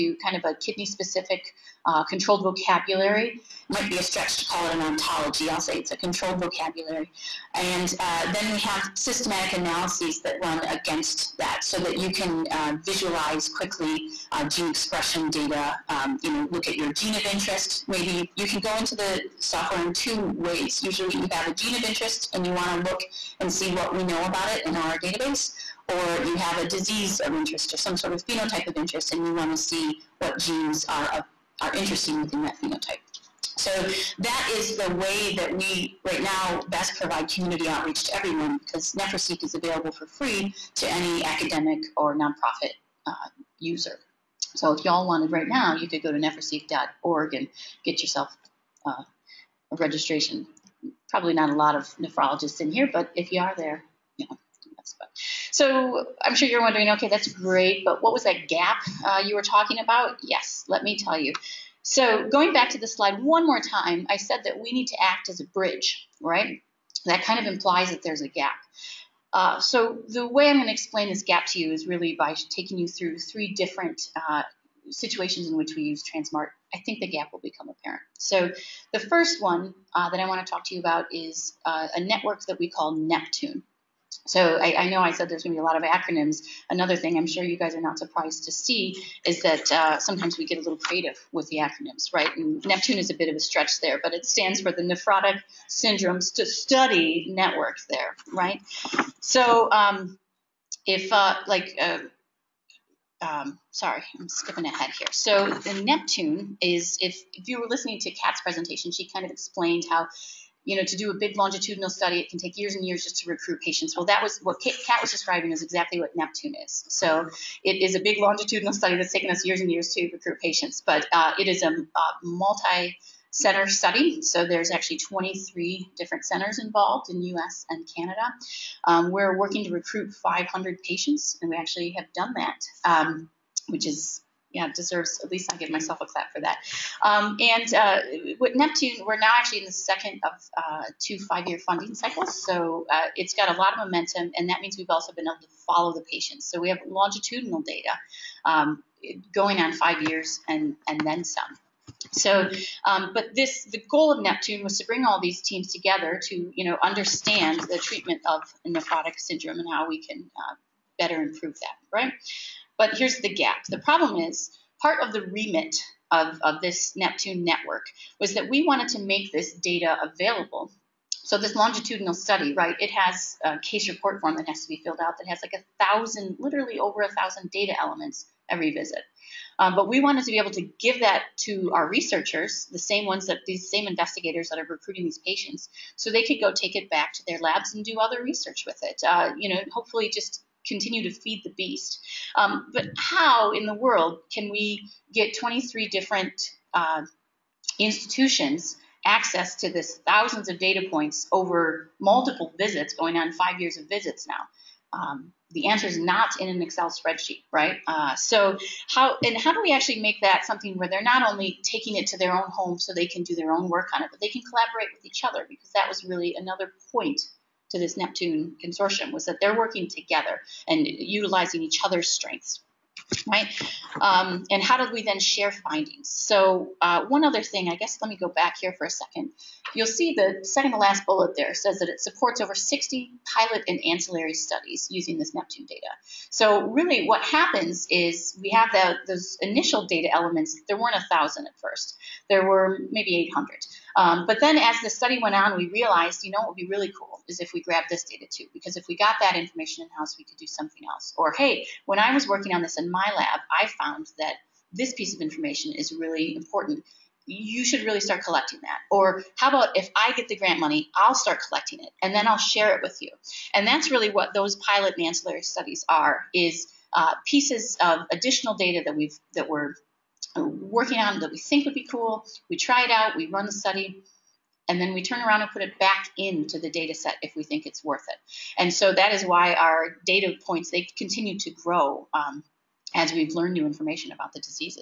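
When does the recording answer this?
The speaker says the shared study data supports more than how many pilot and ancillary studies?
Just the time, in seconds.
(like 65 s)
232 s.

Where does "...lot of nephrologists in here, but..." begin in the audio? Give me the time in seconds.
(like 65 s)
51 s.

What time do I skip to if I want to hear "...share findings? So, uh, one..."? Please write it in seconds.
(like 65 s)
225 s.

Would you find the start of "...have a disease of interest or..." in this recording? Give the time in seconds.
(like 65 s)
26 s.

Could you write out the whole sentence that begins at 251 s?
Or, hey, when I was working on this in my lab, I found that this piece of information is really important.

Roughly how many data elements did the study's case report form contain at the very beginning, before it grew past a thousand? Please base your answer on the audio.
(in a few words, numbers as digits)
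800.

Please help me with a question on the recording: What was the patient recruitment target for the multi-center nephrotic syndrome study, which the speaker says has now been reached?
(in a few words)
500.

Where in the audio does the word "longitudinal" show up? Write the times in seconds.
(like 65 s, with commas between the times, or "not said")
111 s, 118 s, 146 s, 171 s.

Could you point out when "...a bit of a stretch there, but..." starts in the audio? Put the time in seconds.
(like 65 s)
93 s.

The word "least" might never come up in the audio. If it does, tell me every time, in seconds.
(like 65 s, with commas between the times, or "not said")
135 s.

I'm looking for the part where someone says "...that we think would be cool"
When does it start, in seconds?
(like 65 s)
271 s.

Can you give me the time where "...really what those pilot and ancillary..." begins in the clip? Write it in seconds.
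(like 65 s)
263 s.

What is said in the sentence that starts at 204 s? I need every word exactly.
Um, the answer is not in an Excel spreadsheet, right?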